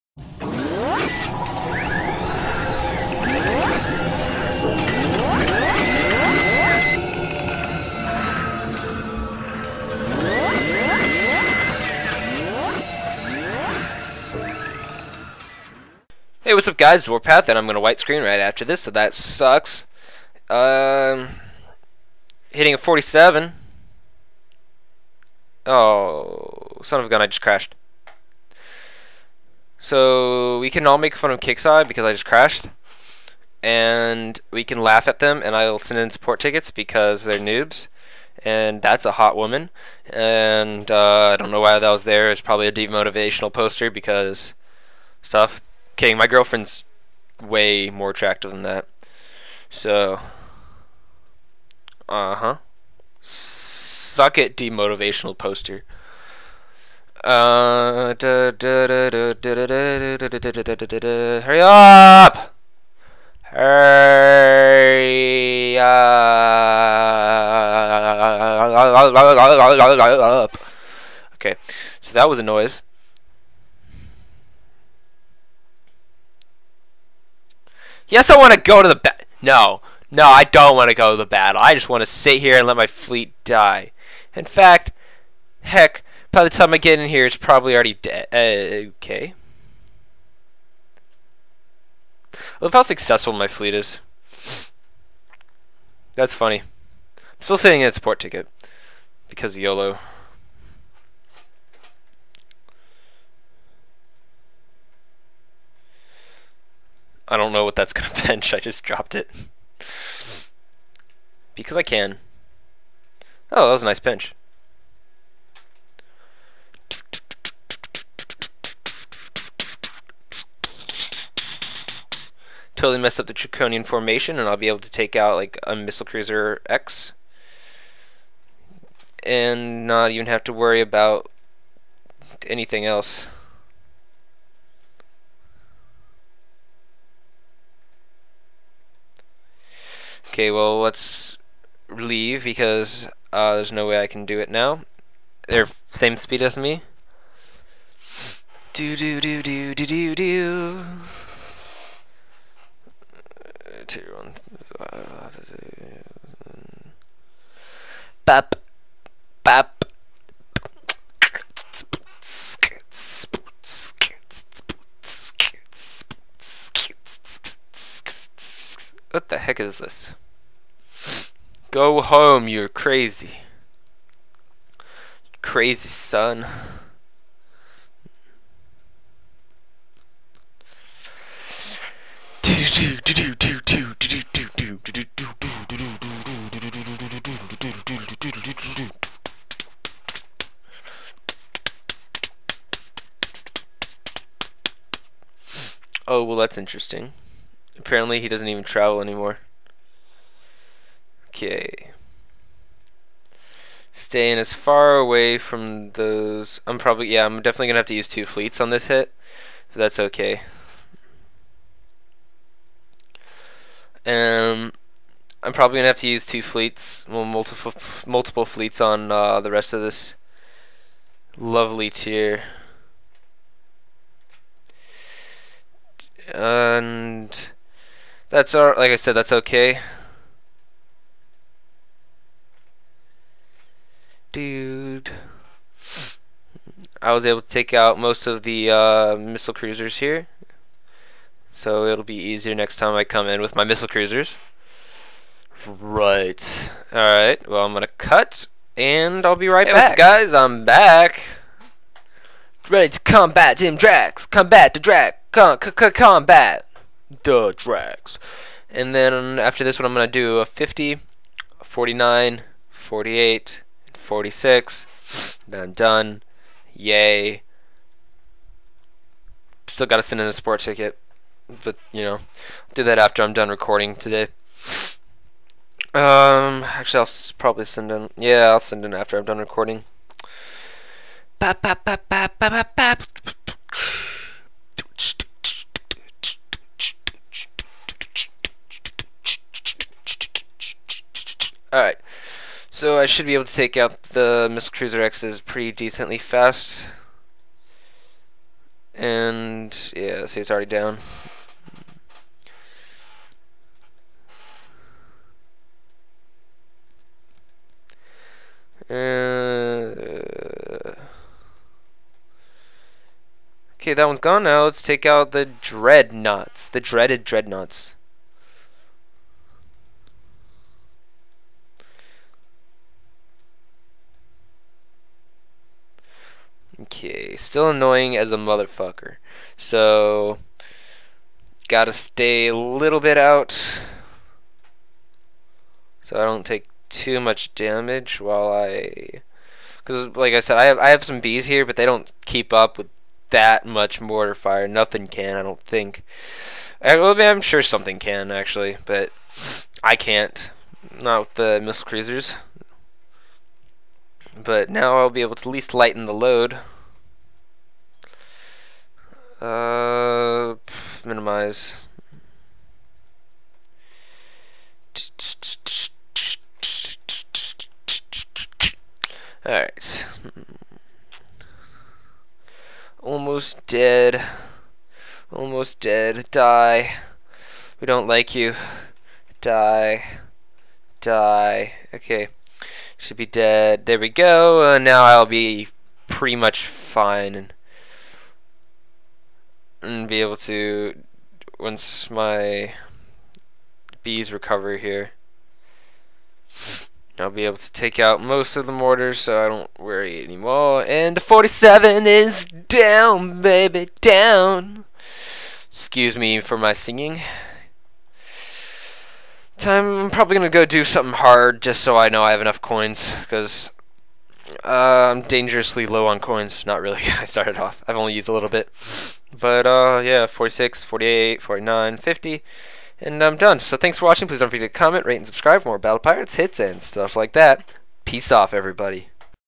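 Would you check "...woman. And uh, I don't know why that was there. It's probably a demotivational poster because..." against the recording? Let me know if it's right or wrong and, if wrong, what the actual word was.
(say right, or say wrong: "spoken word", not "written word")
right.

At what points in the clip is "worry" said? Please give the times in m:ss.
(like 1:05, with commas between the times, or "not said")
2:10, 6:39.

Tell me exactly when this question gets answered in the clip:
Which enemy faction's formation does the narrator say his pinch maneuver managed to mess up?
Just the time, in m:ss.
2:03.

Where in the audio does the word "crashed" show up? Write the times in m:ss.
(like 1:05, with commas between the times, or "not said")
0:27, 0:32.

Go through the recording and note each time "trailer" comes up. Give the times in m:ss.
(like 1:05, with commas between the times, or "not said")
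not said.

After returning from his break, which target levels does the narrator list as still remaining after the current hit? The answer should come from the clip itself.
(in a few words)
50, 49, 48, and 46.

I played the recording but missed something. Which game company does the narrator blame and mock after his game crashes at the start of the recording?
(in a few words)
Kixeye.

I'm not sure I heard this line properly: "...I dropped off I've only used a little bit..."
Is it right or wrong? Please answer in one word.
wrong.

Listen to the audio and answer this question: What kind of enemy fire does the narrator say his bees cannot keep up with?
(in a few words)
mortar fire.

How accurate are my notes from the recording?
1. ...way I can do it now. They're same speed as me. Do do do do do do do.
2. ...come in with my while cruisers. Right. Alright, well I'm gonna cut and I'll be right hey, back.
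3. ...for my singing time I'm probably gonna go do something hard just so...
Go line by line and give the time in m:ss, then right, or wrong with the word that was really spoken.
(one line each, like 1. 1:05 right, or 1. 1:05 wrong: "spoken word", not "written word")
1. 2:23 right
2. 4:03 wrong: "missile", not "while"
3. 6:46 right.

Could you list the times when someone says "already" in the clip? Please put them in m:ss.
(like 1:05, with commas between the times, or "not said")
1:27, 5:00.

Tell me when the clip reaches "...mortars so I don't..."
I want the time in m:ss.
6:38.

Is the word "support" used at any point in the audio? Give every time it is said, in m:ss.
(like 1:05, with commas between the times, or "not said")
0:36, 1:37.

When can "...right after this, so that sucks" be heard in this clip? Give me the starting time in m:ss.
0:18.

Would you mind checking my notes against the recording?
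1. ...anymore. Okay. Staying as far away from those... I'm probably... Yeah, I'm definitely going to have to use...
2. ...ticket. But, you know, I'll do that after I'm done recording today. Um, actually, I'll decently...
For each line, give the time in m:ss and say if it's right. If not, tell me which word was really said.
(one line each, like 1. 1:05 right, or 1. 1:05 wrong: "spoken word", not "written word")
1. 3:19 right
2. 4:30 wrong: "probably", not "decently".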